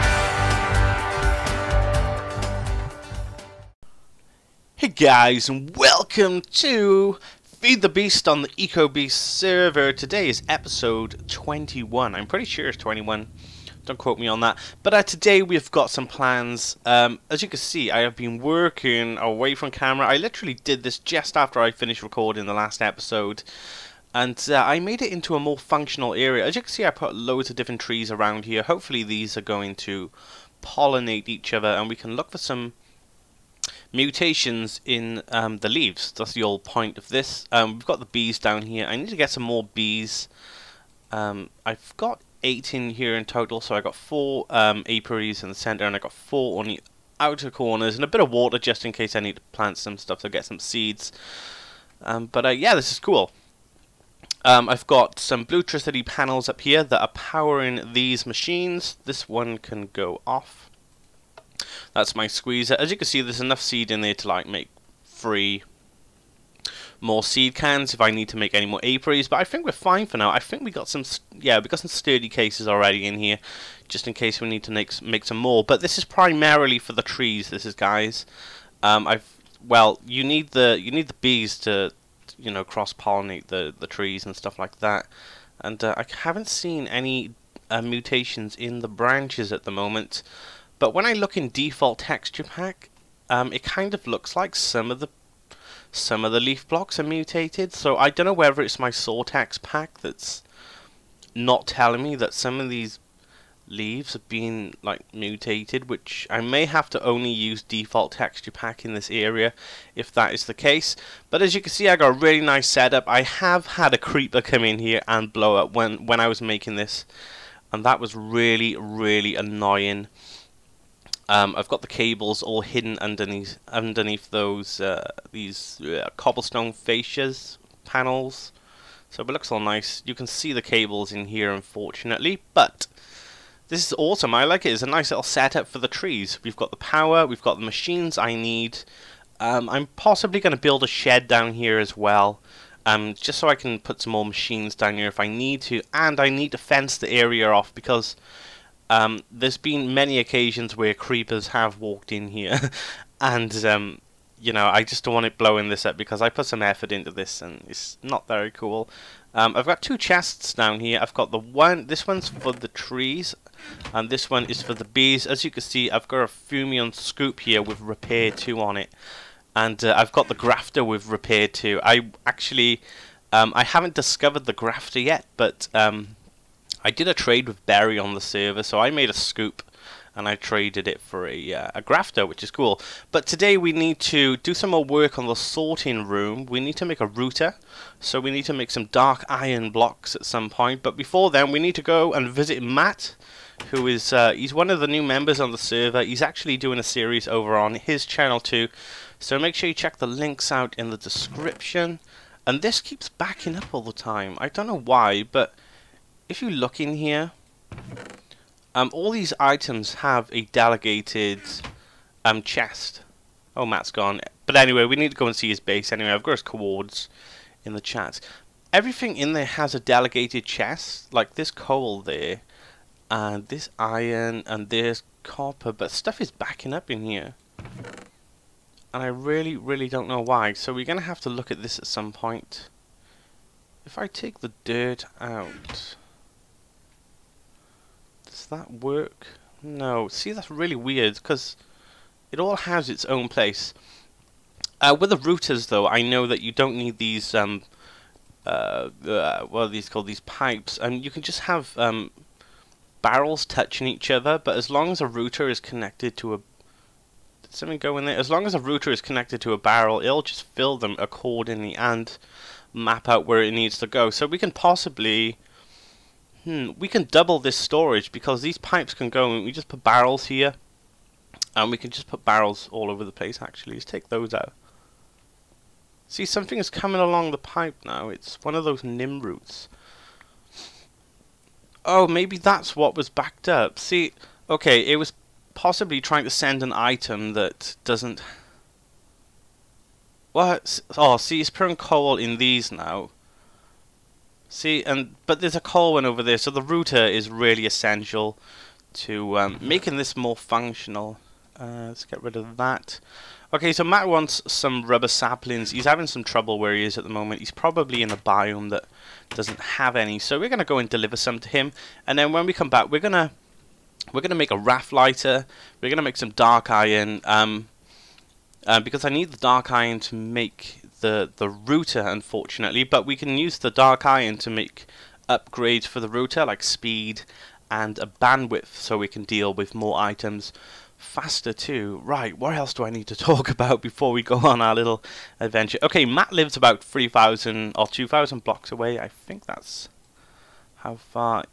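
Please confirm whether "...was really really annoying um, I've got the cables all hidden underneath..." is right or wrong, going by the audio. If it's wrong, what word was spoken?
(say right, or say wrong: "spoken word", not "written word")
right.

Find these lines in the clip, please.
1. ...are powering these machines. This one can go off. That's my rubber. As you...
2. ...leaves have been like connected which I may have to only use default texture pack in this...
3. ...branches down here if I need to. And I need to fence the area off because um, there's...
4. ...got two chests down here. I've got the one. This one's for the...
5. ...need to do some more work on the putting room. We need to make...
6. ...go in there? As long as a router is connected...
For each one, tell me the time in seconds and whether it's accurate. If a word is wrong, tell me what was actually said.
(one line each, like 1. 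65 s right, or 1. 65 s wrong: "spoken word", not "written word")
1. 57 s wrong: "squeezer", not "rubber"
2. 103 s wrong: "mutated", not "connected"
3. 144 s wrong: "machines", not "branches"
4. 159 s right
5. 183 s wrong: "sorting", not "putting"
6. 257 s right.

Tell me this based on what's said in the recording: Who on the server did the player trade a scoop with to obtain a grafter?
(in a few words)
Barry.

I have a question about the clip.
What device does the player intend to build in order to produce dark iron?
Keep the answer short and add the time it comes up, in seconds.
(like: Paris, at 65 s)
Wrath Igniter, at 314 s.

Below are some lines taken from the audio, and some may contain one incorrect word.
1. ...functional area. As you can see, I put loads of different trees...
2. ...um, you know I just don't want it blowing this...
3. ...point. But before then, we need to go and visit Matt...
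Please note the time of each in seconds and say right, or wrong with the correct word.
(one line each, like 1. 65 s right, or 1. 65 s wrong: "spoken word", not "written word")
1. 25 s right
2. 153 s right
3. 190 s right.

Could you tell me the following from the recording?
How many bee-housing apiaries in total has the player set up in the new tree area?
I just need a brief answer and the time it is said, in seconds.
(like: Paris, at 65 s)
8, at 42 s.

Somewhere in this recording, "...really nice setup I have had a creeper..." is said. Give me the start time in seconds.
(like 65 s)
112 s.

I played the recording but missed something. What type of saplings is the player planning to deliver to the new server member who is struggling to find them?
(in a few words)
Rubber saplings.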